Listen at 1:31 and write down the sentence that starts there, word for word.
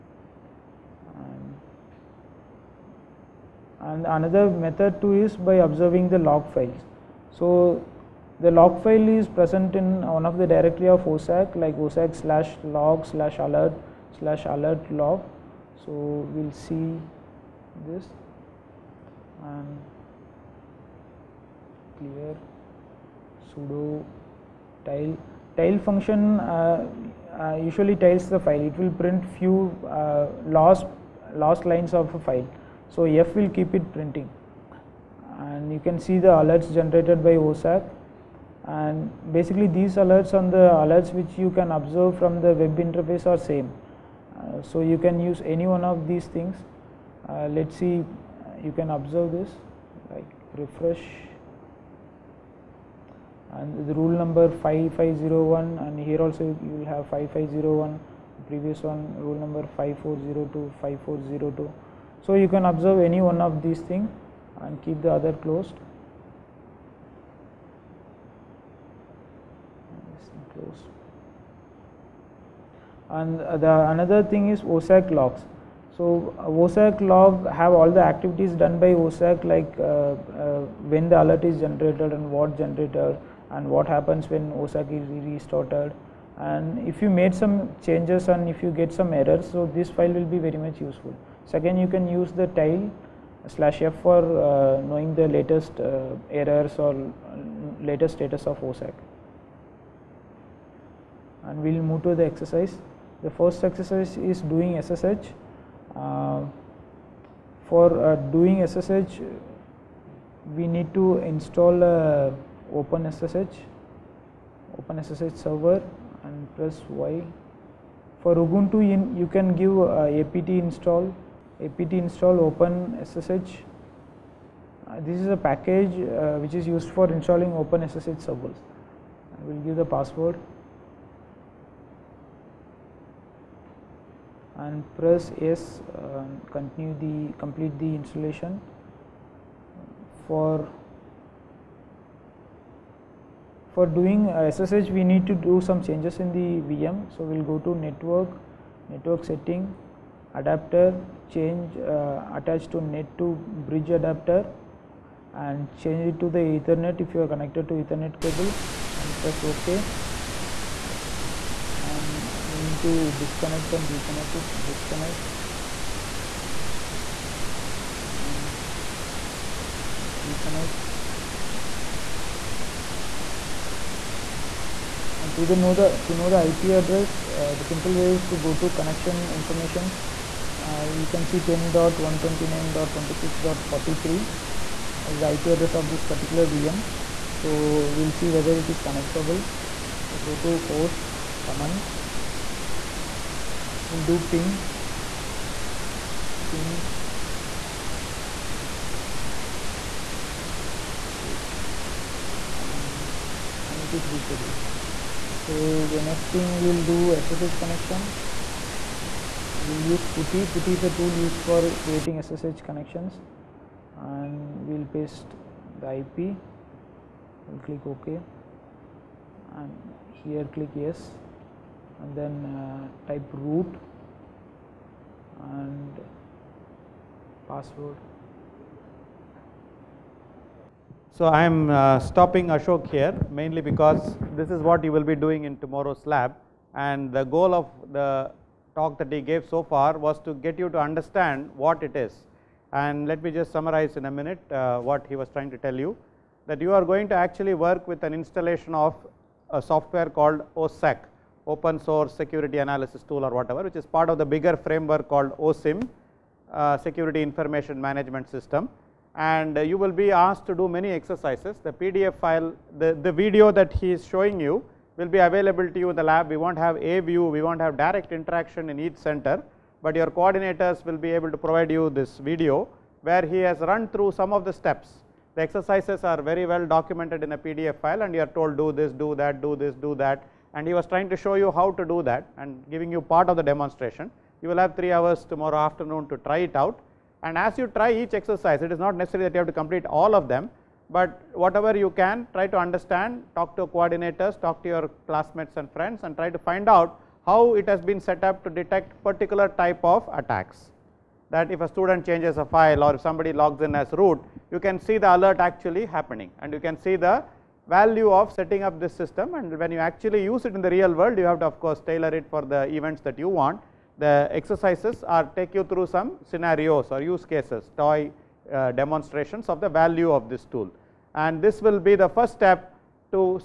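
Second, you can use the tile slash f for uh, knowing the latest uh, errors or uh, latest status of OSSEC.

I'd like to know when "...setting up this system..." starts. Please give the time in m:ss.
5:08.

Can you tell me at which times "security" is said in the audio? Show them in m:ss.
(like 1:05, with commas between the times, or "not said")
4:12, 4:16.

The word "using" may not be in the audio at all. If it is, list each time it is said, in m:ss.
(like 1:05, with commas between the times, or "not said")
not said.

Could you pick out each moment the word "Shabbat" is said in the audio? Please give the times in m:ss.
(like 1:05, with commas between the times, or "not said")
not said.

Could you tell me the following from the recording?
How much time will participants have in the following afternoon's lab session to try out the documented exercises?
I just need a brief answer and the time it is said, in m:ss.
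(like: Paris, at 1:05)
3 hours, at 4:44.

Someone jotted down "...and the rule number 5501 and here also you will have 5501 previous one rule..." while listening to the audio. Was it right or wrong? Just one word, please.
right.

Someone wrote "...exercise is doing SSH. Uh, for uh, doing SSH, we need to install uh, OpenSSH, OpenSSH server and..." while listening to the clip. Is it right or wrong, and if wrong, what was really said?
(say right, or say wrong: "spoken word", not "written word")
right.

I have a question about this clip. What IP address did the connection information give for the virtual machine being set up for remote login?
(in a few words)
10.129.26.43.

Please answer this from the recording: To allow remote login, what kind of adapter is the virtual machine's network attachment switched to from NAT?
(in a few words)
bridge adapter.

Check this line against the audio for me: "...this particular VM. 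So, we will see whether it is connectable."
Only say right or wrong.
right.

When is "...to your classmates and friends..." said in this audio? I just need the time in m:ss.
4:54.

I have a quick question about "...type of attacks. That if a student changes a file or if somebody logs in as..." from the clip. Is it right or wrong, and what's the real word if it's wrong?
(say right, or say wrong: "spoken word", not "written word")
right.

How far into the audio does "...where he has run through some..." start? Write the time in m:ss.
4:33.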